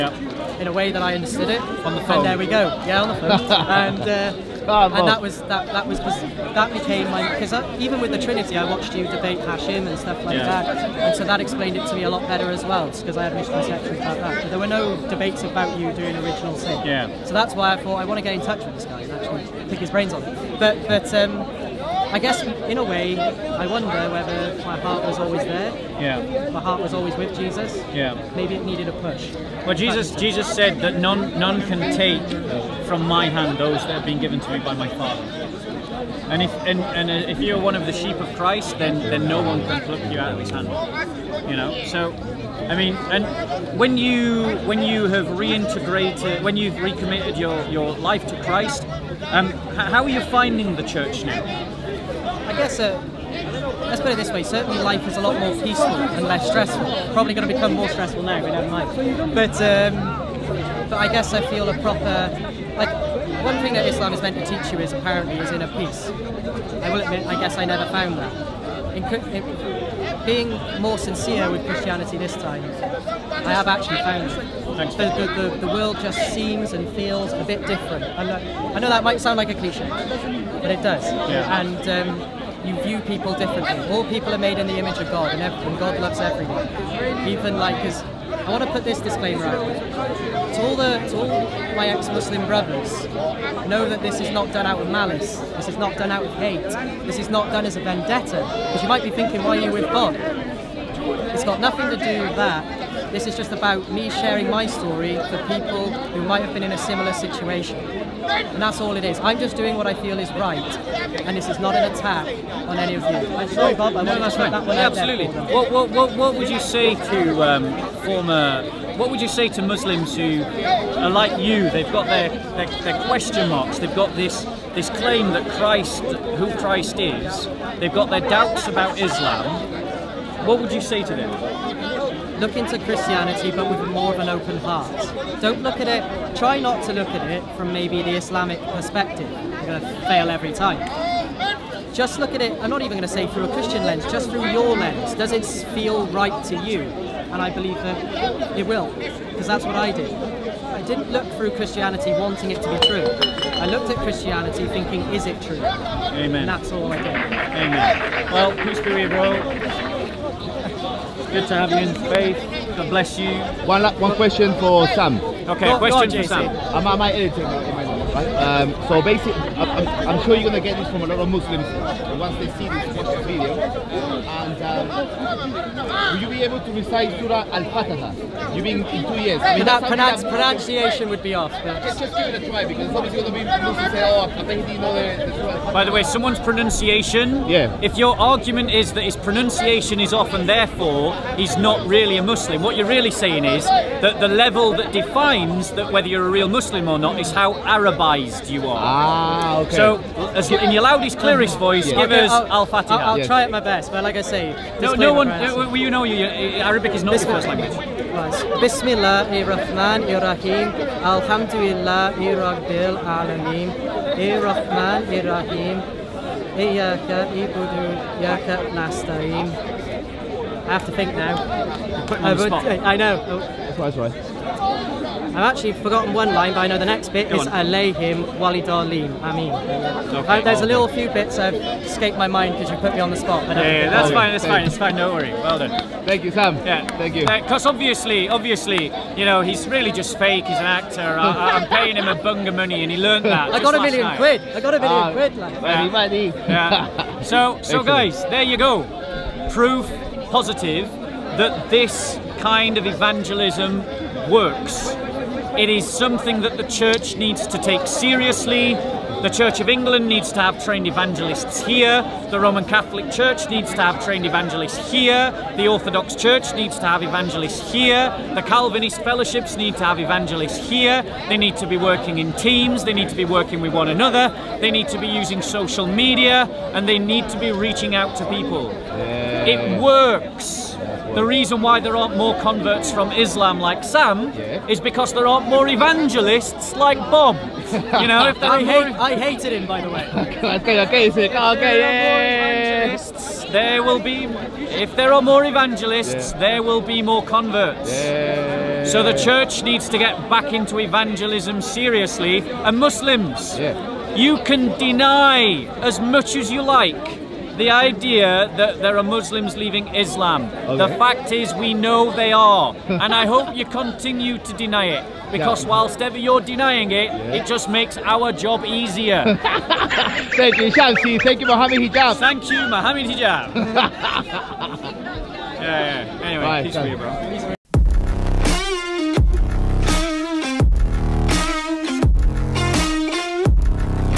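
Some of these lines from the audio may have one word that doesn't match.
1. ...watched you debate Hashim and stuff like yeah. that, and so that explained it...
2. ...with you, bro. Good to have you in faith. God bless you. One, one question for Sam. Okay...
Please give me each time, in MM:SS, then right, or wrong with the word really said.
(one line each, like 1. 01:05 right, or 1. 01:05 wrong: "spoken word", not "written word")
1. 00:08 right
2. 02:38 right.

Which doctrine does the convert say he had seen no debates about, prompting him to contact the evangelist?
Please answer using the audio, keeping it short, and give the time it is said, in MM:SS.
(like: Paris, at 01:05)
Original sin, at 00:16.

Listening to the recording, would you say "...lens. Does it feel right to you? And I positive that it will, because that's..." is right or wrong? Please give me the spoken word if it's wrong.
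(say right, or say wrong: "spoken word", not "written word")
wrong: "believe", not "positive".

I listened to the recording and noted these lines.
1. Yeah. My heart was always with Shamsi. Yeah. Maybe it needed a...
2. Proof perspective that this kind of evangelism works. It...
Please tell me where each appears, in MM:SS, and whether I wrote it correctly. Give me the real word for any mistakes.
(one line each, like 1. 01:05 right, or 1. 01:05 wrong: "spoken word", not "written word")
1. 00:26 wrong: "Jesus", not "Shamsi"
2. 04:09 wrong: "positive", not "perspective".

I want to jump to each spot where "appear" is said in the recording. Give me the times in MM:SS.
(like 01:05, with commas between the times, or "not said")
not said.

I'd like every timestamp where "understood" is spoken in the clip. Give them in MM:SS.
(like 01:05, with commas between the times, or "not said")
00:01.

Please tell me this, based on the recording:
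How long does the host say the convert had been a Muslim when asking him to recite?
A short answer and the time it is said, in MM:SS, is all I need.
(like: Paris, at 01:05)
Two years, at 02:59.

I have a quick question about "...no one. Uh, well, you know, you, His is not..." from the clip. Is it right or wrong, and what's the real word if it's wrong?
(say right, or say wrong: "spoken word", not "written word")
wrong: "Arabic", not "His".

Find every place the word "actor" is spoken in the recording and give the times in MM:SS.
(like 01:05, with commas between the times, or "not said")
04:00.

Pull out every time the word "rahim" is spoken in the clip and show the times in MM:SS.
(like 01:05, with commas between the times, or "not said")
03:30, 03:35.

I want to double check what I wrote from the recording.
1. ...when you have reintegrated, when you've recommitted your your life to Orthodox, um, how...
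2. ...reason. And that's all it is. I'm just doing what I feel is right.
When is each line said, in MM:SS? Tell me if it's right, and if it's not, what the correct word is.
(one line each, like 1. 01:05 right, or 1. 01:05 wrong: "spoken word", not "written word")
1. 00:44 wrong: "Christ", not "Orthodox"
2. 01:47 wrong: "situation", not "reason".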